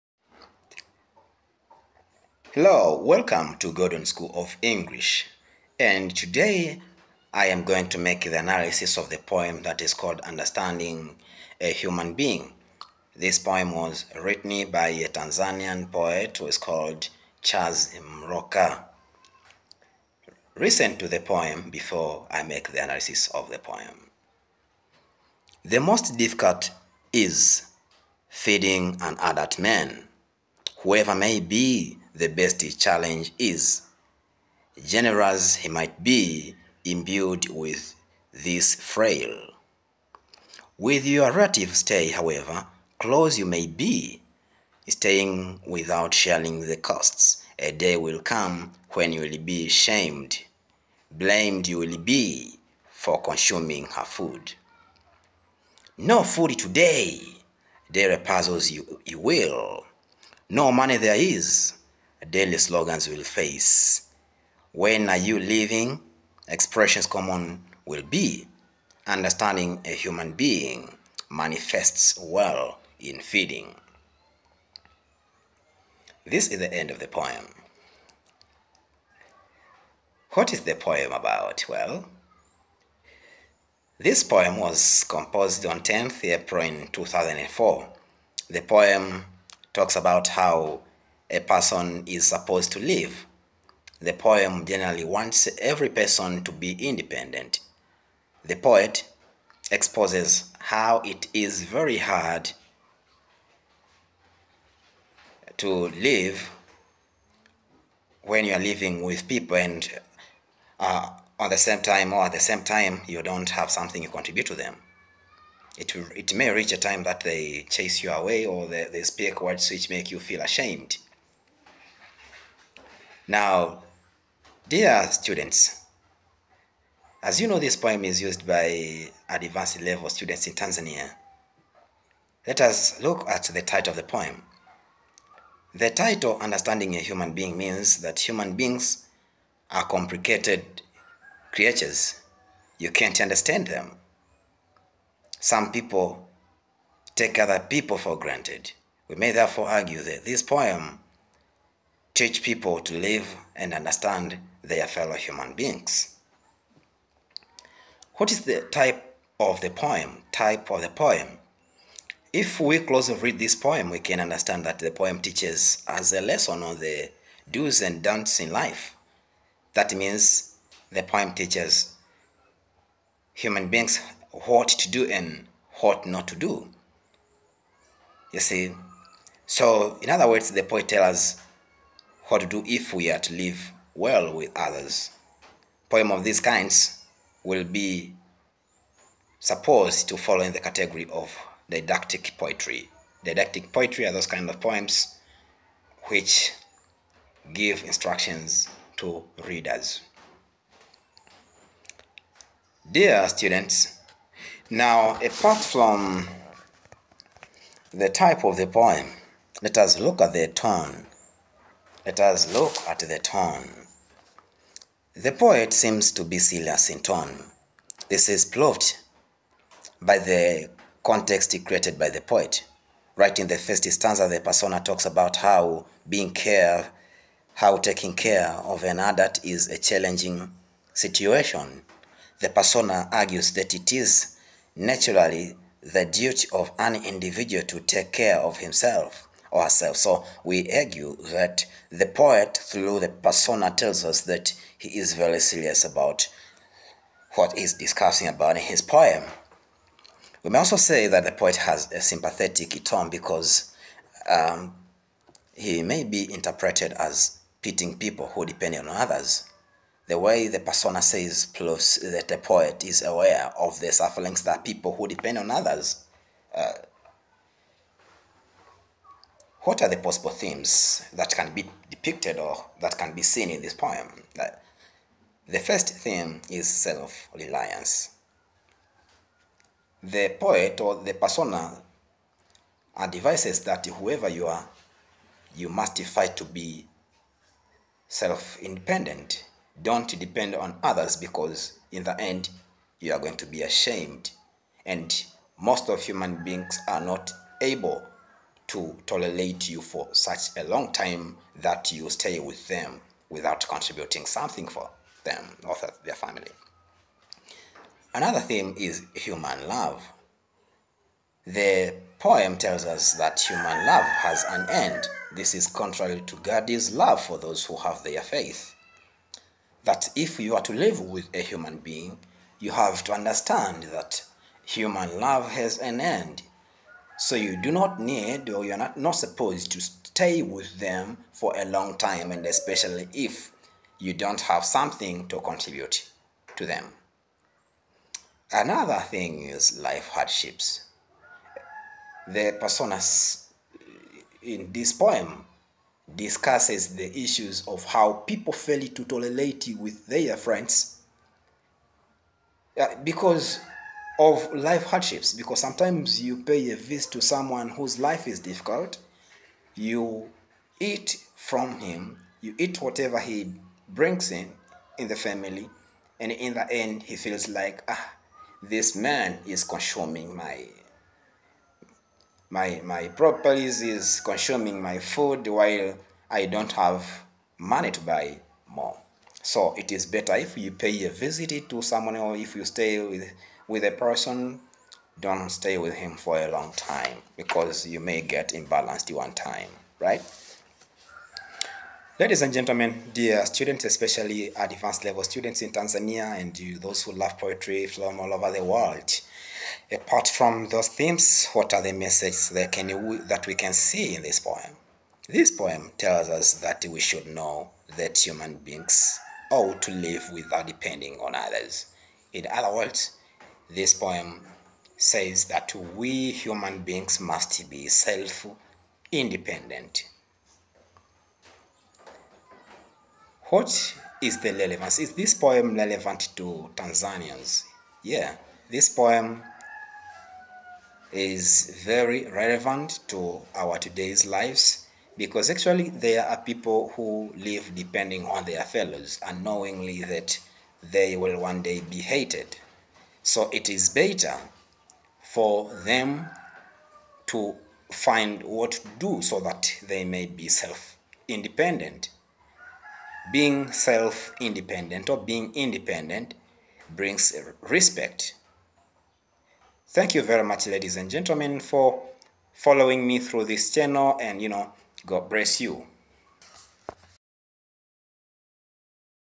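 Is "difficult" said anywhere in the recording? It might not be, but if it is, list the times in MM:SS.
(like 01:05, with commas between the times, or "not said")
00:26, 05:58.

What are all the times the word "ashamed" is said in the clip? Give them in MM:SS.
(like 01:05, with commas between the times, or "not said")
02:00, 04:53.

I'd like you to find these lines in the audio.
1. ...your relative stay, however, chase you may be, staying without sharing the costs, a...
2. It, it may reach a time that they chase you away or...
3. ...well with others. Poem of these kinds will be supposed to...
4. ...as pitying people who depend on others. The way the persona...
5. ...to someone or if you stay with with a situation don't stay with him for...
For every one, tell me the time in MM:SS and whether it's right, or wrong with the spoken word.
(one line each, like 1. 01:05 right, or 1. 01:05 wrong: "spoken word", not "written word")
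1. 00:41 wrong: "close", not "chase"
2. 01:55 right
3. 03:03 right
4. 04:16 right
5. 06:21 wrong: "person", not "situation".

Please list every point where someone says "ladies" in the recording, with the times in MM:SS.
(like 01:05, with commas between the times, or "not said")
06:32, 07:40.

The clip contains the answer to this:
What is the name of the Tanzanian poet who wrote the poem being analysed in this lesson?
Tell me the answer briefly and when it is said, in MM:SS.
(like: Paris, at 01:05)
Charles Mloka, at 00:17.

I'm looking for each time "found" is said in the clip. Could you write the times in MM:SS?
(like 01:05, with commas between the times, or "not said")
not said.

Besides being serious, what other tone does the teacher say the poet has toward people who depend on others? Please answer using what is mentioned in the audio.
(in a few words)
Sympathetic.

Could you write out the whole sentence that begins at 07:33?
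Being self independent or being independent brings respect.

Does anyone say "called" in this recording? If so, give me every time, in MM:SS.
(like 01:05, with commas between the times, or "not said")
00:09, 00:16.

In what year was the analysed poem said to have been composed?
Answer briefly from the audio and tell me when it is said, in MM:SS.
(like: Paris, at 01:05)
2004, at 01:26.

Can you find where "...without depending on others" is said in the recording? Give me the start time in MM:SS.
06:50.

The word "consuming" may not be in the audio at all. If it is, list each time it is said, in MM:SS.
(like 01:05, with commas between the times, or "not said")
00:53, 06:09, 06:14.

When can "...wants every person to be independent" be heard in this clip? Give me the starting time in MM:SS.
01:35.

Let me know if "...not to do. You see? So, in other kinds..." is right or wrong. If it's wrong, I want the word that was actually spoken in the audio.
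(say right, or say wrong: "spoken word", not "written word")
wrong: "words", not "kinds".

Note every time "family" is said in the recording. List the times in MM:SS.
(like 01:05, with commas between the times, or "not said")
05:06, 06:05.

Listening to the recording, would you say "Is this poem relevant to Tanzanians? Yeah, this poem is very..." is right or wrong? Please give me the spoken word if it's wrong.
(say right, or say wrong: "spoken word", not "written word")
right.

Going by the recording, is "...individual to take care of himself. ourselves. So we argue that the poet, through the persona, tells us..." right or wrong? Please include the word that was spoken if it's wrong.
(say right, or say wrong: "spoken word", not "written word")
right.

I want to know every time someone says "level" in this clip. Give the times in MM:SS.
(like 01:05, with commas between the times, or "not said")
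02:09, 06:35.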